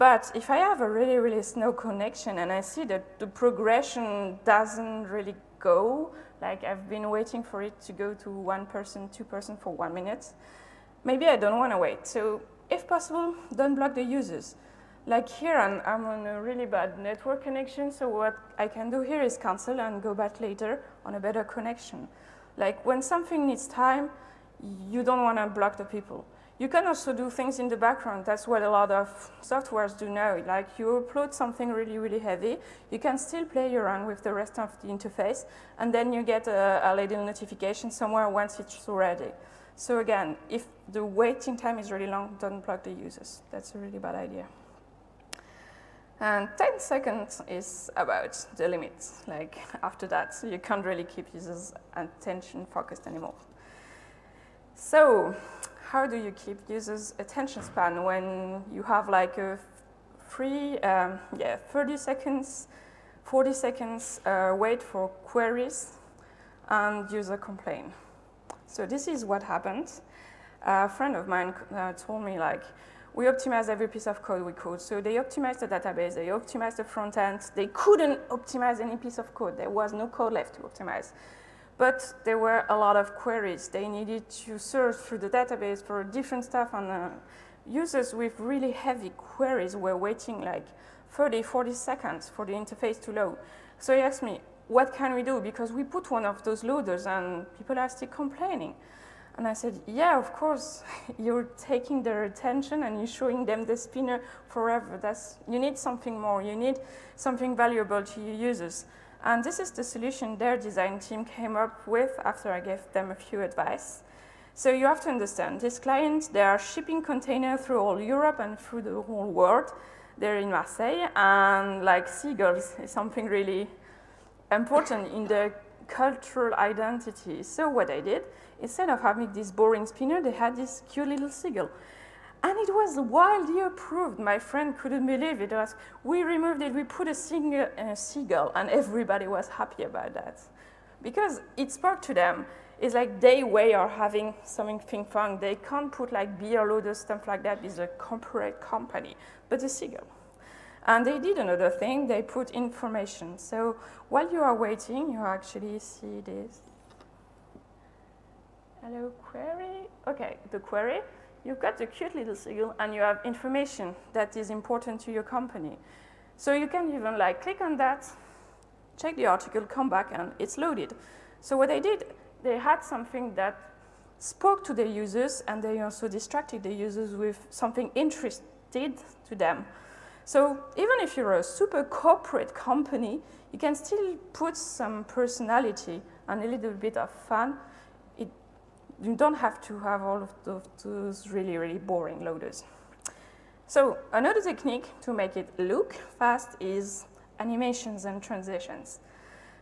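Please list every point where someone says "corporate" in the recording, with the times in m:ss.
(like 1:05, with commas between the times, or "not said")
2:27, 3:01.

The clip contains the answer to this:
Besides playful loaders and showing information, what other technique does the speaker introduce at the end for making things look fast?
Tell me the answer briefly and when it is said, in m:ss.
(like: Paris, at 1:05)
Animations and transitions, at 3:17.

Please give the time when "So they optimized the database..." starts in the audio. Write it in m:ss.
1:14.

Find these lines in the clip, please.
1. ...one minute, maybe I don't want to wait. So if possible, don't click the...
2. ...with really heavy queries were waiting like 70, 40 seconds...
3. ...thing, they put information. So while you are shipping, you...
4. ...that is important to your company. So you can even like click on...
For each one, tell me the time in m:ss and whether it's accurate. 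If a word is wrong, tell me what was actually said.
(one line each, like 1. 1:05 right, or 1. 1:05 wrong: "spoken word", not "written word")
1. 0:09 wrong: "block", not "click"
2. 1:28 wrong: "30", not "70"
3. 2:31 wrong: "waiting", not "shipping"
4. 2:44 right.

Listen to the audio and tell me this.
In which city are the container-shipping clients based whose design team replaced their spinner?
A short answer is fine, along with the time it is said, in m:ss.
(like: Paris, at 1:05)
Marseille, at 2:00.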